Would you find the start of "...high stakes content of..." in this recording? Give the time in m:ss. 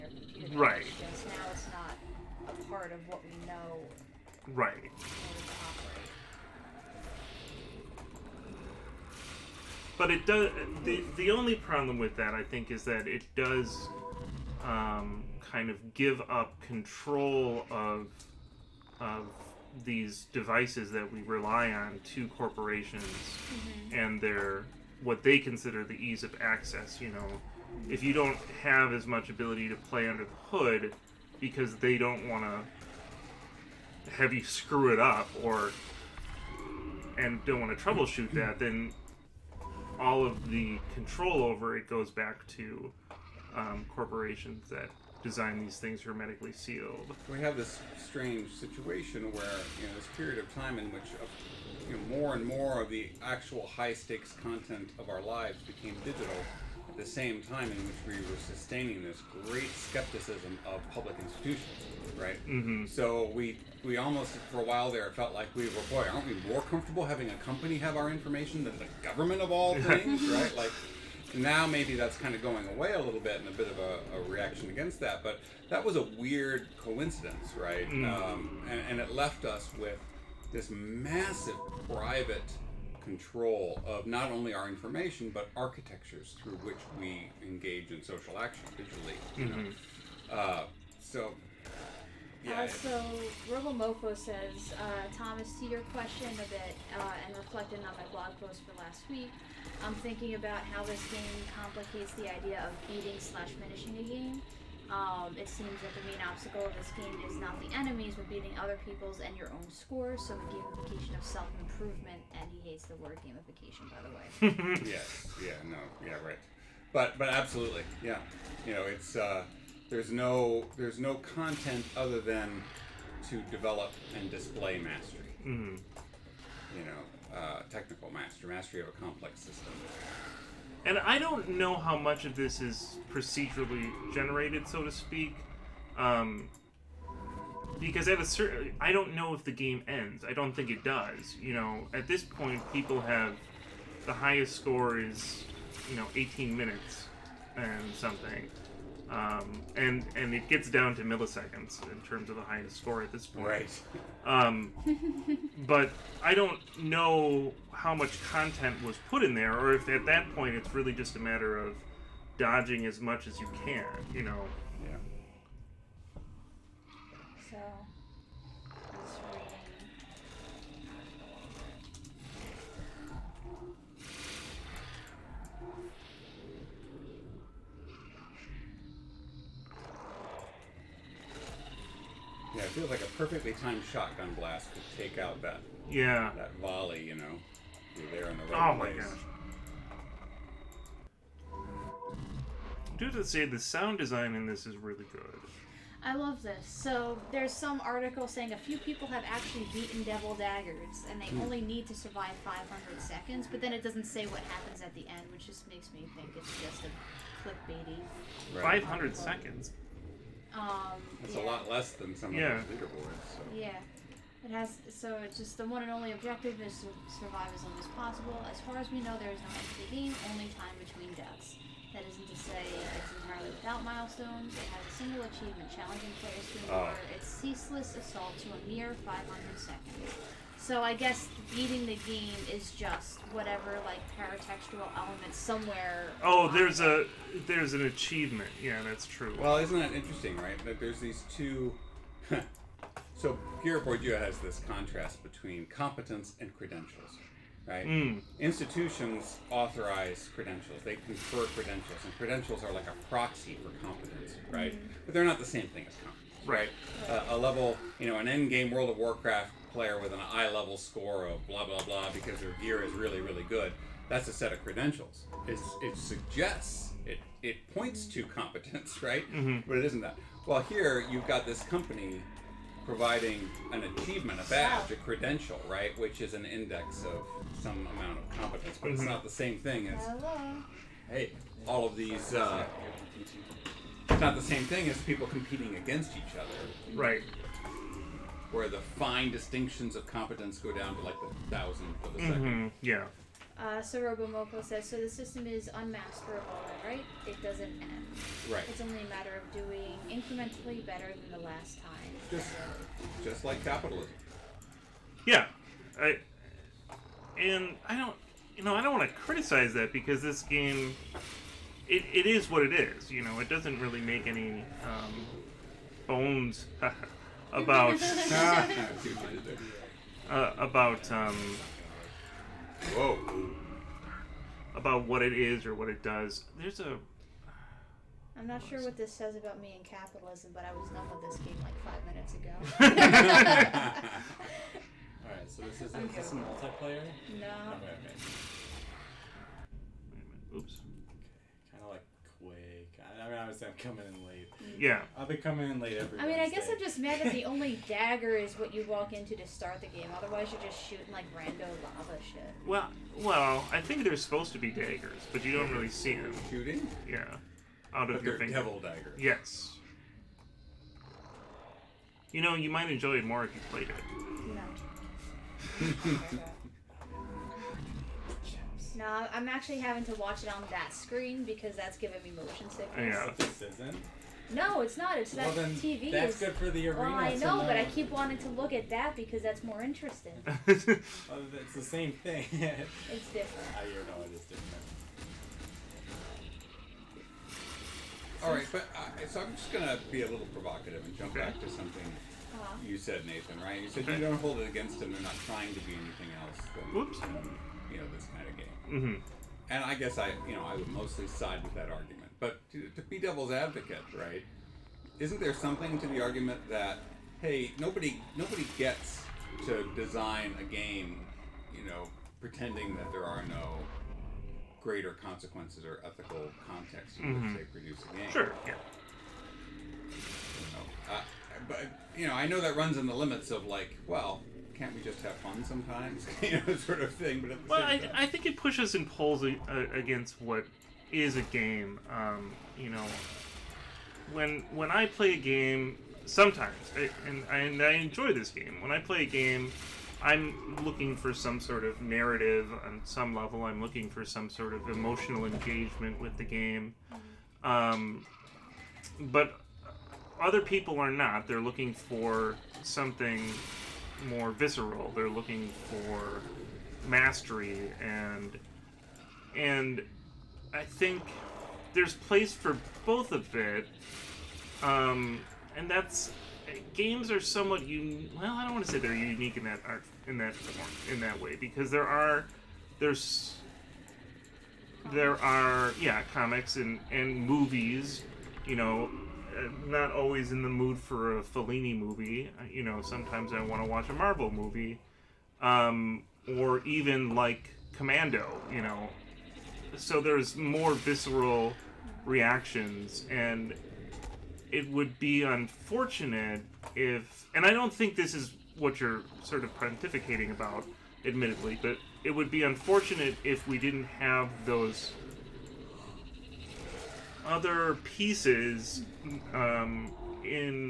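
0:53.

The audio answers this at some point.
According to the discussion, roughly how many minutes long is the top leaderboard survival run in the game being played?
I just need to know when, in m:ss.
2:26.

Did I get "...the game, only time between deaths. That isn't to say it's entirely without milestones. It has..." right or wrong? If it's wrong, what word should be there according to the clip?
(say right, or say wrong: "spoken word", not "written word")
right.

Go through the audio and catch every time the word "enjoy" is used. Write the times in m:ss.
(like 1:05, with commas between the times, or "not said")
6:02, 7:17.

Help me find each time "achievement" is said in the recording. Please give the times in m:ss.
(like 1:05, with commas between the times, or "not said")
3:45, 3:57, 4:33.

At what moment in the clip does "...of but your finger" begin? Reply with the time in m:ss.
5:58.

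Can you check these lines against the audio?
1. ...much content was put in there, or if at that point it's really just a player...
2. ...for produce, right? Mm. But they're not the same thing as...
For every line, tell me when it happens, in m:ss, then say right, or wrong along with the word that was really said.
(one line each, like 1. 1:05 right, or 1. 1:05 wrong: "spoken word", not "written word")
1. 2:37 wrong: "matter", not "player"
2. 4:13 wrong: "competence", not "produce".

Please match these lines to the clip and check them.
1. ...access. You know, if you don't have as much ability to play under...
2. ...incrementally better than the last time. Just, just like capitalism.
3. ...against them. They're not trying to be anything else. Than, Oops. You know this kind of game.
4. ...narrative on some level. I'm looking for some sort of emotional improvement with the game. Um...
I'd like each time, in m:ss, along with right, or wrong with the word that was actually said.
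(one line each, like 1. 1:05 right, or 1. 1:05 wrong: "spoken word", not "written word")
1. 0:26 right
2. 5:00 right
3. 6:34 right
4. 7:22 wrong: "engagement", not "improvement".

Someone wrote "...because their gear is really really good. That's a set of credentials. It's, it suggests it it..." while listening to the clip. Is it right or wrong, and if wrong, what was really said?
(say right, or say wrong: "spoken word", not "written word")
right.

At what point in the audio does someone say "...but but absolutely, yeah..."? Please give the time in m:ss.
1:56.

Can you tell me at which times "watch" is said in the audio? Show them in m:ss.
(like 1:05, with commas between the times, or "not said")
6:10, 8:03.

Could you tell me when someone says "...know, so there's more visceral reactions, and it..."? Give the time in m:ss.
8:08.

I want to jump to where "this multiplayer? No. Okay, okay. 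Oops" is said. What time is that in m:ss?
5:36.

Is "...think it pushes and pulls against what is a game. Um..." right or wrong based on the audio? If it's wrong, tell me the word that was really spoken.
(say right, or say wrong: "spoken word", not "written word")
right.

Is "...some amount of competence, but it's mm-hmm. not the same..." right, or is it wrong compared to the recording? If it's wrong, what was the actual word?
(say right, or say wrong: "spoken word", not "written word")
right.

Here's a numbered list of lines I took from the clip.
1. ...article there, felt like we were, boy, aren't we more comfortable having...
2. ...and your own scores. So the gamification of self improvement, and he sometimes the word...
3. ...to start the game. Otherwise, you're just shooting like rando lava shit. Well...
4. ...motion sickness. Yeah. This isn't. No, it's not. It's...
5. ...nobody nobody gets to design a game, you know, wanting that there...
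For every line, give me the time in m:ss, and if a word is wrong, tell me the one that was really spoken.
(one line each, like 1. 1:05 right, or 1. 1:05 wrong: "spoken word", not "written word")
1. 1:04 wrong: "while", not "article"
2. 1:49 wrong: "hates", not "sometimes"
3. 5:49 right
4. 6:12 right
5. 6:47 wrong: "pretending", not "wanting".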